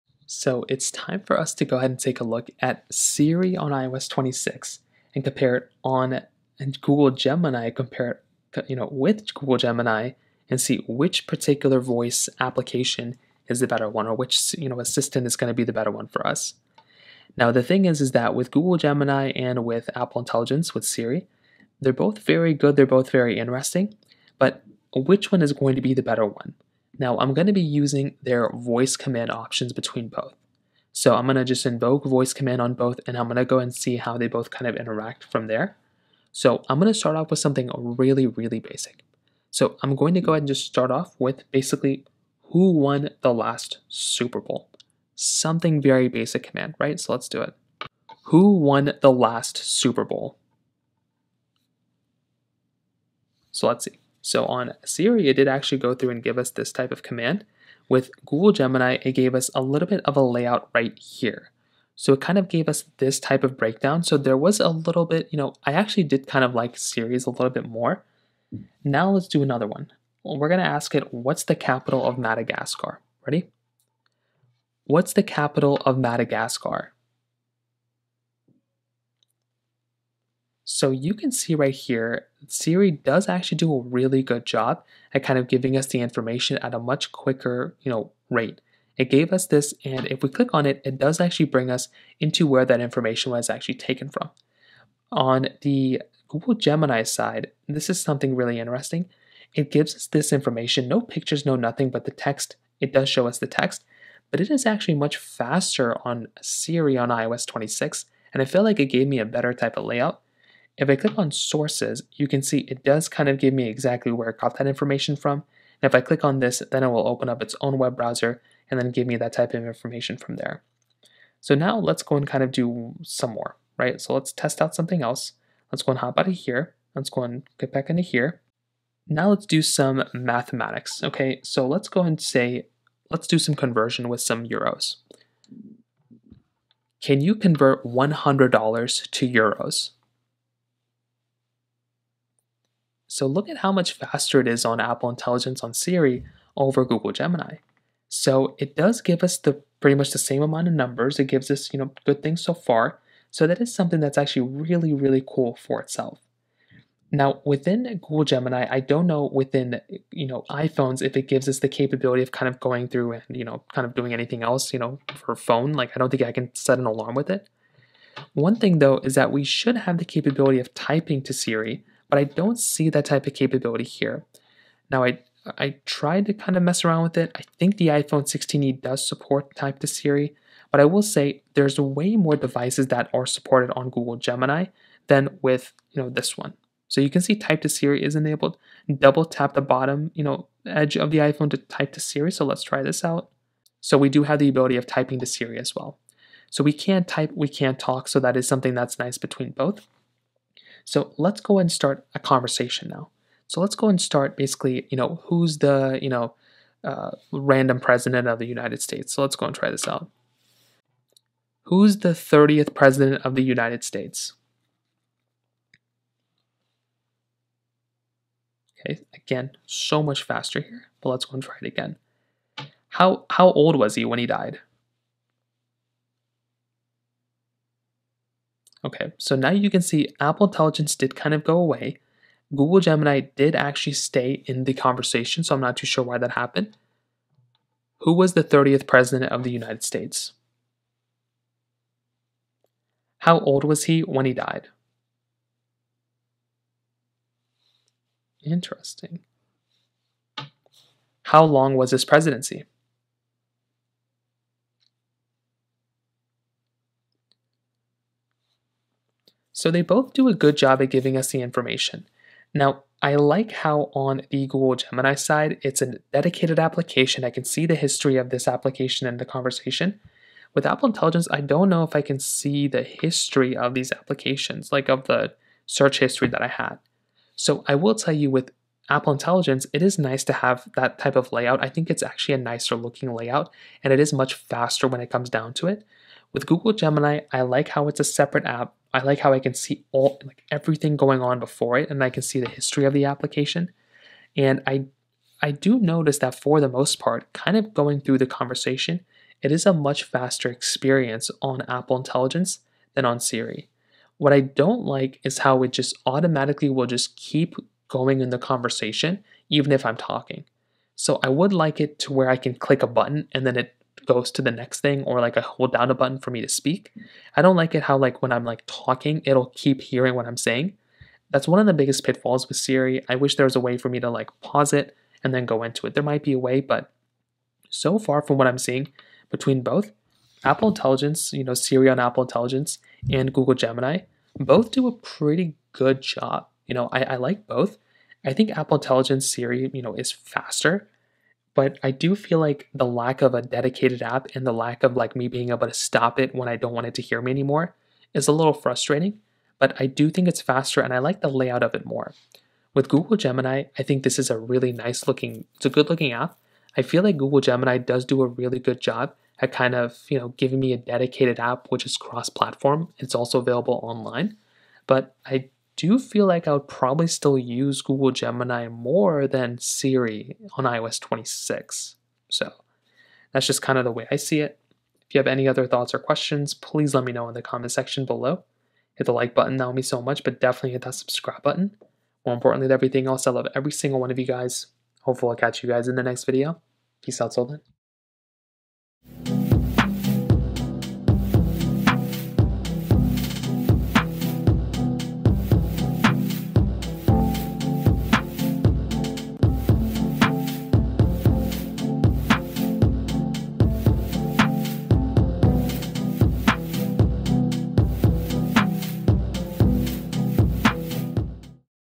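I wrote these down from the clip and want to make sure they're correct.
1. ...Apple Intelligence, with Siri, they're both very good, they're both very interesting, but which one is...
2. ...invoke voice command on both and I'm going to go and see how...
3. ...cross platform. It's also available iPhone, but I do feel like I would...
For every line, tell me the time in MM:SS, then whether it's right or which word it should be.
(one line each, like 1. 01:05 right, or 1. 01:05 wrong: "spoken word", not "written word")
1. 00:19 right
2. 00:31 right
3. 06:01 wrong: "online", not "iPhone".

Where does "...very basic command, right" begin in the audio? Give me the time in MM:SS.
00:45.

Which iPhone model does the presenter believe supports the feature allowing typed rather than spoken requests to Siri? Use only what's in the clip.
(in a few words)
iPhone 16e.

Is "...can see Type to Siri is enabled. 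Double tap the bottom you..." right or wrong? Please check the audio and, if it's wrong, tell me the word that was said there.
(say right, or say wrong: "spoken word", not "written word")
right.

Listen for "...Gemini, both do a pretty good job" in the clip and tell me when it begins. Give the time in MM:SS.
05:33.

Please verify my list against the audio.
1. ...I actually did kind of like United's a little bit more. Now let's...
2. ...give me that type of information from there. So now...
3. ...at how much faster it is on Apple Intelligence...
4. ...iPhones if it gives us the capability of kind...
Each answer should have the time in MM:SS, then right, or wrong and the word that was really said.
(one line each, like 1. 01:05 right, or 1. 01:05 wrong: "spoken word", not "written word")
1. 01:05 wrong: "Siri", not "United"
2. 01:58 right
3. 02:23 right
4. 02:40 right.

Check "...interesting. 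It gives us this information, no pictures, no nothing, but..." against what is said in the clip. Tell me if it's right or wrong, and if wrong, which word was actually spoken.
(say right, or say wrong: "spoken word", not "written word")
right.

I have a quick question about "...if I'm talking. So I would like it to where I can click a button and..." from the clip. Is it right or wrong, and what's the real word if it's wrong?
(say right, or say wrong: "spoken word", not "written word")
right.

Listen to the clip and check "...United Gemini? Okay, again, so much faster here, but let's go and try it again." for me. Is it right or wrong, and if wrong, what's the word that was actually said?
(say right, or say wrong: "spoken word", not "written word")
wrong: "States", not "Gemini".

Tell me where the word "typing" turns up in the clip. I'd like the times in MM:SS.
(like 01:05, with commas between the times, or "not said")
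02:50, 03:14.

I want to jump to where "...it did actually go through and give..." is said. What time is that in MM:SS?
00:55.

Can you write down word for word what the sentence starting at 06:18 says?
Hit the like button, that would mean so much, but definitely hit that subscribe button.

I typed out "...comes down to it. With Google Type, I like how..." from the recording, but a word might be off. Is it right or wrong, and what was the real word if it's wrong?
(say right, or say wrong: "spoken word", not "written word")
wrong: "Gemini", not "Type".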